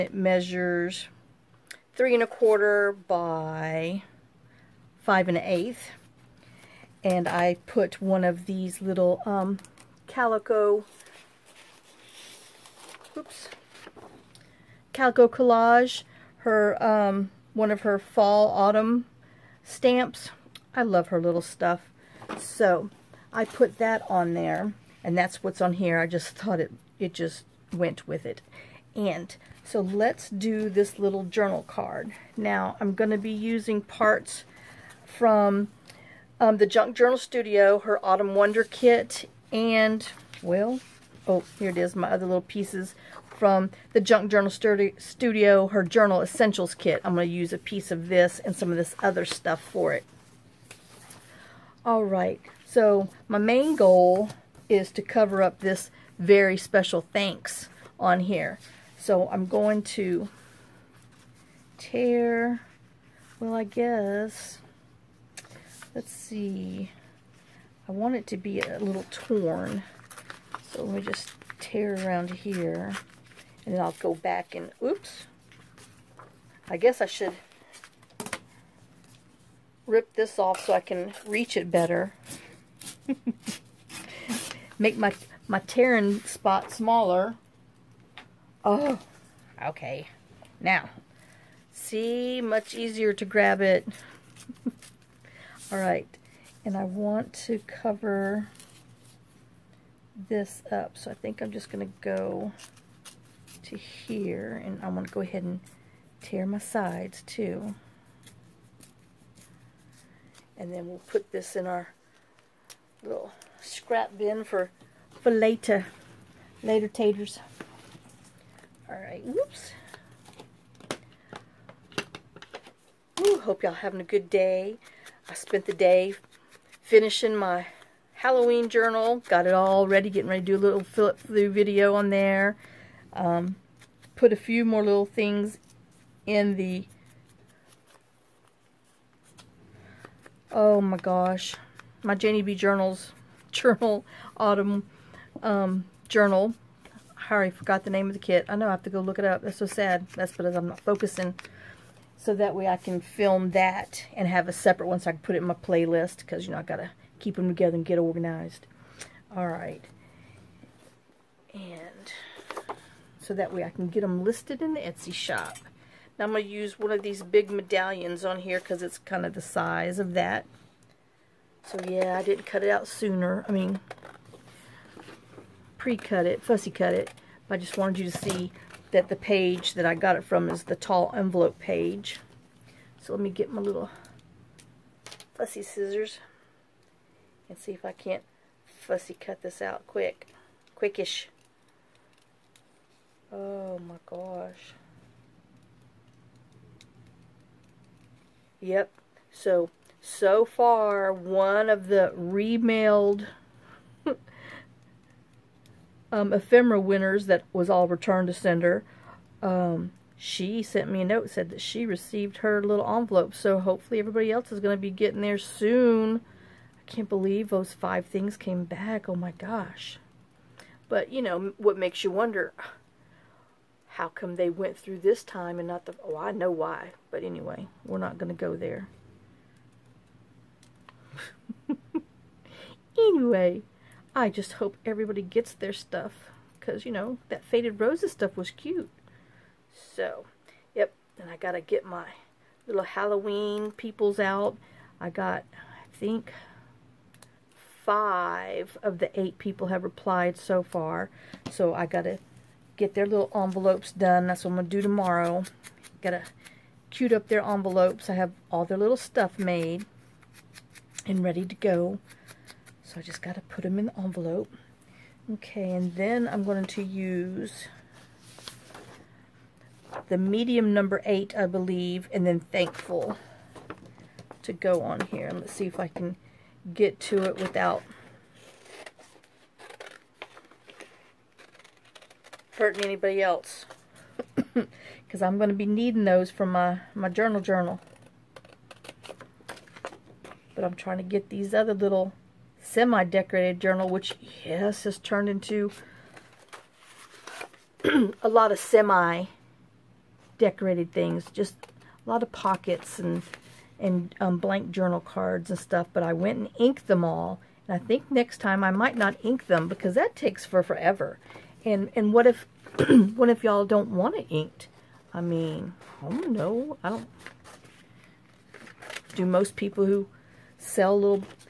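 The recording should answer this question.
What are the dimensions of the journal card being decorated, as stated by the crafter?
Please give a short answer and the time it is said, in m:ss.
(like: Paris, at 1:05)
3 1/4 by 5 1/8, at 0:01.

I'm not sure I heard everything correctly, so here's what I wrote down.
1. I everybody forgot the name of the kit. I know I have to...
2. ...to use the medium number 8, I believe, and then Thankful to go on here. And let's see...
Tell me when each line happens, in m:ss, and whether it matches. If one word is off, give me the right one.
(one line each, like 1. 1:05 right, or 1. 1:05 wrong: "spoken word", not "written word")
1. 2:27 wrong: "already", not "everybody"
2. 4:26 right.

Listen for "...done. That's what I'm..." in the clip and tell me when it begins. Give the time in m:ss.
4:13.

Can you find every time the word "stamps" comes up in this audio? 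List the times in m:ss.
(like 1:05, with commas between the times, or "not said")
0:19.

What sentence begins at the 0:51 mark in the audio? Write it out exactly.
All right, so my main goal is to cover up this very special thanks on here.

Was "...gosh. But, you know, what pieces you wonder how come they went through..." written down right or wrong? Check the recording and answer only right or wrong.
wrong.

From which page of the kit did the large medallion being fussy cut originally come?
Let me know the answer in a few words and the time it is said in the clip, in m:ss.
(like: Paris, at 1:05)
Tall envelope page, at 3:00.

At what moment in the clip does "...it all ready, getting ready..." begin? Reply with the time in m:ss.
2:09.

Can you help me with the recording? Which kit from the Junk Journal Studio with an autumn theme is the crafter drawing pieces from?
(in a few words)
Autumn Wonder Kit.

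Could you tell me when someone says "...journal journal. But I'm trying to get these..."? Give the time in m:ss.
4:47.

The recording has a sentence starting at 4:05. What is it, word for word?
I got, I think, five of the eight people have replied so far.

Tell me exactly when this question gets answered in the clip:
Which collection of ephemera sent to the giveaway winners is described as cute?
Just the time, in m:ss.
3:57.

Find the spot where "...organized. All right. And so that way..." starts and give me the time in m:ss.
2:37.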